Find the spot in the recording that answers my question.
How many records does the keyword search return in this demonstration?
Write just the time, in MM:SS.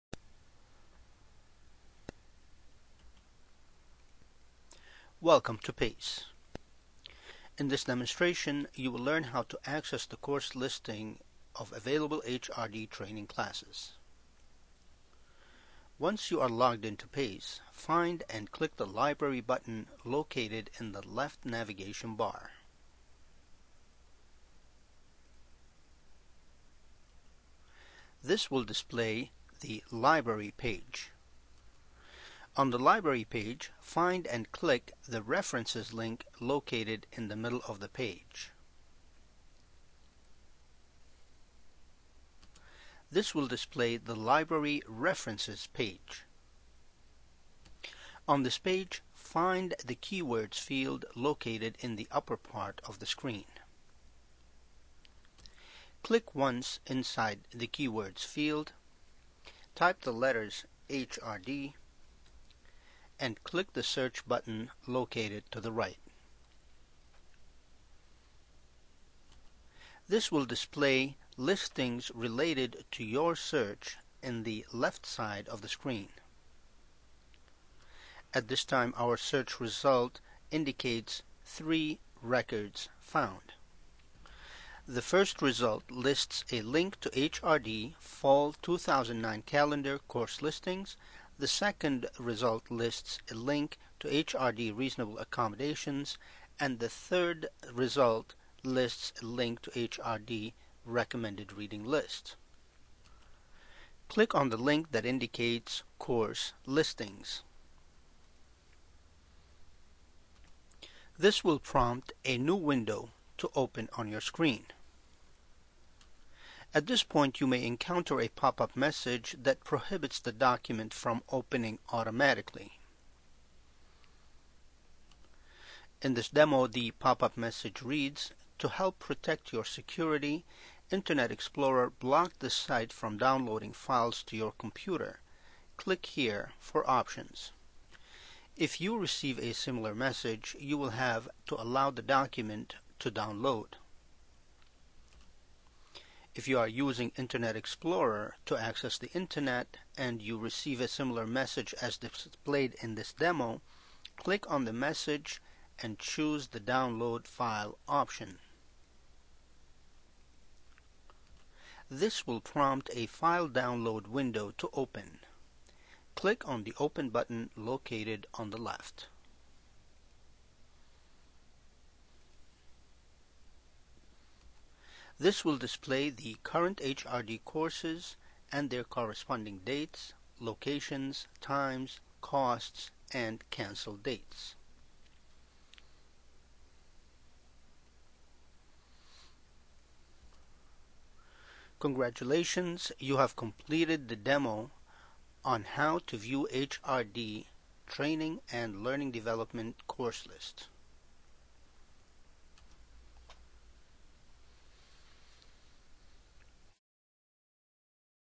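01:21.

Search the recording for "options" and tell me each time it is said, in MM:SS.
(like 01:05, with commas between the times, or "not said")
02:16, 02:37.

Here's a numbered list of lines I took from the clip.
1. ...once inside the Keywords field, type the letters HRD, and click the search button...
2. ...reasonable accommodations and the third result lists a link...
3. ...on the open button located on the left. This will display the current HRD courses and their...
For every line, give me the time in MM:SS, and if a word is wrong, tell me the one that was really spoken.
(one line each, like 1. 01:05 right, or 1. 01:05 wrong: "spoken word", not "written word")
1. 00:56 right
2. 01:34 right
3. 02:46 right.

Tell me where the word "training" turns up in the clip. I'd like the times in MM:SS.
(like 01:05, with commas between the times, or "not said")
00:12, 03:17.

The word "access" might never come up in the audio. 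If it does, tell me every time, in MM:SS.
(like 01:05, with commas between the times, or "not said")
00:09, 02:28.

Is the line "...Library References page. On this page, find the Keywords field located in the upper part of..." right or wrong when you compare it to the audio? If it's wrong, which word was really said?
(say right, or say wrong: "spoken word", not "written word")
right.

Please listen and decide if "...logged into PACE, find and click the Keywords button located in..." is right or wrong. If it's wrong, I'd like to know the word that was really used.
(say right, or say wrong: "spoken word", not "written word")
wrong: "Library", not "Keywords".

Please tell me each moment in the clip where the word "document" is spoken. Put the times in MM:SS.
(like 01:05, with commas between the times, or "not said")
02:00, 02:22.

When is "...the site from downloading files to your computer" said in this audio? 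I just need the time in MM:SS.
02:12.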